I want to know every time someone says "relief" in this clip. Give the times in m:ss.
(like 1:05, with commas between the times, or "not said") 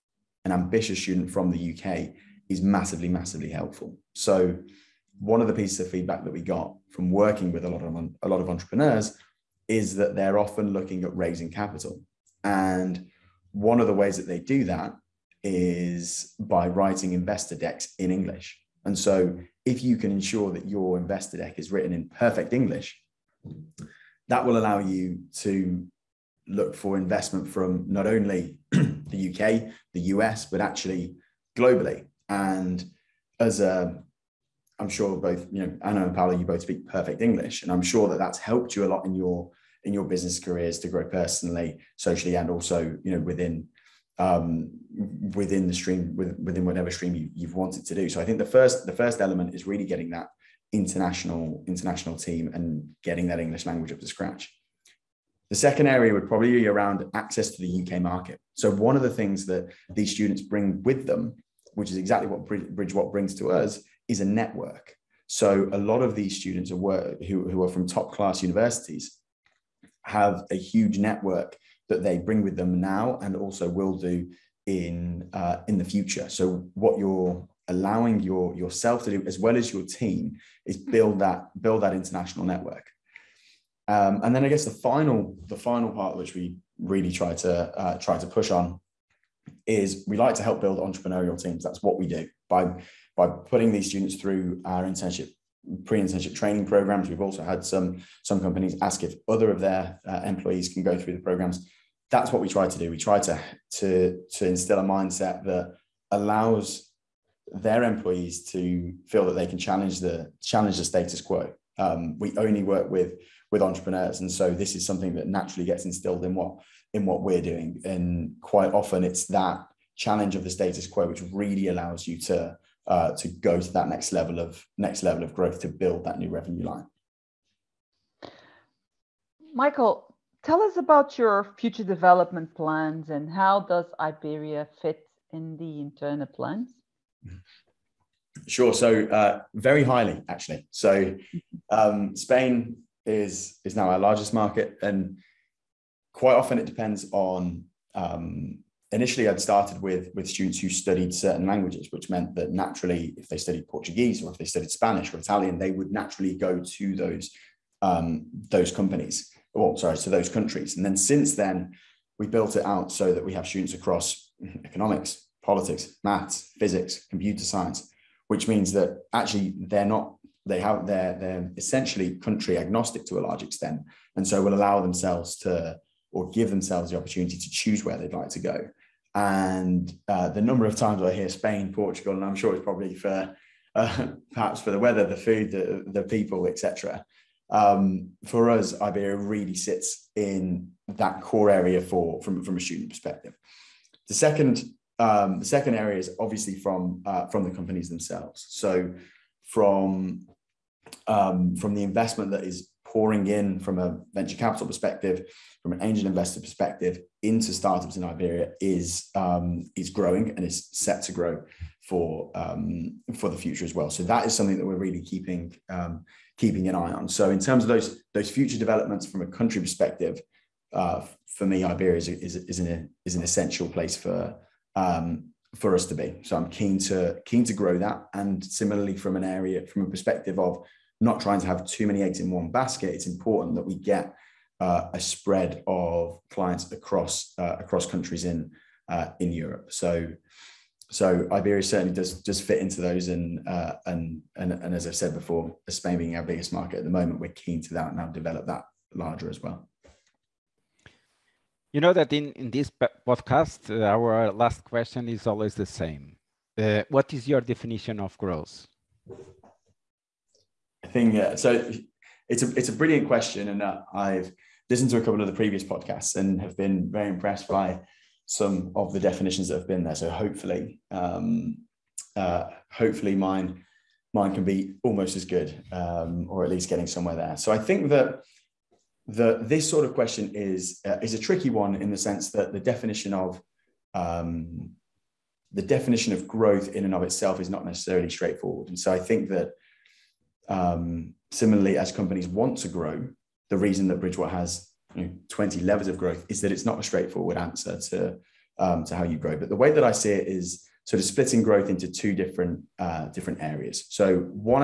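not said.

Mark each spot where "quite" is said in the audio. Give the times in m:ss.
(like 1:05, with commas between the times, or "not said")
1:58, 2:26.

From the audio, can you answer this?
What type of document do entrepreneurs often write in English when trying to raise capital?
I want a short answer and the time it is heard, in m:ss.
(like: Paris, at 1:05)
Investor decks, at 0:17.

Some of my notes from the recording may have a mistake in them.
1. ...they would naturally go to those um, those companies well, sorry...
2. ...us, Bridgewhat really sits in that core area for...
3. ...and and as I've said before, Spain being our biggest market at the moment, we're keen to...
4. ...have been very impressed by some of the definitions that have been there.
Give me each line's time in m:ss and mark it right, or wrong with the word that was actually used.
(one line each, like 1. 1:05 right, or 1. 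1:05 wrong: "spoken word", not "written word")
1. 2:35 right
2. 3:08 wrong: "Iberia", not "Bridgewhat"
3. 4:04 right
4. 4:26 right.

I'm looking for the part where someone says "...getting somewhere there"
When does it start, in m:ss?
4:36.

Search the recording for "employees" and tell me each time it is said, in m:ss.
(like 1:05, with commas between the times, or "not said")
1:40, 1:47.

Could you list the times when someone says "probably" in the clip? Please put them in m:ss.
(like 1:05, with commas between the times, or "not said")
0:56, 3:02.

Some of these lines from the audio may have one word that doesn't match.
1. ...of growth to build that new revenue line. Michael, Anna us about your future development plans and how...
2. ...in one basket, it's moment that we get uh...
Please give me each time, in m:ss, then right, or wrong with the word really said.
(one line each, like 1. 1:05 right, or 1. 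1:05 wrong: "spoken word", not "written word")
1. 2:05 wrong: "Tell", not "Anna"
2. 3:52 wrong: "important", not "moment".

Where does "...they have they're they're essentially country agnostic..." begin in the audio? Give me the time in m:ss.
2:50.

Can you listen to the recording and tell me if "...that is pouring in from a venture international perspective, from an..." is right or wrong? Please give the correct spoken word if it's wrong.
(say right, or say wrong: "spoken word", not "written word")
wrong: "capital", not "international".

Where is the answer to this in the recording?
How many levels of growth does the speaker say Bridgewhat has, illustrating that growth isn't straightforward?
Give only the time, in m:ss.
4:55.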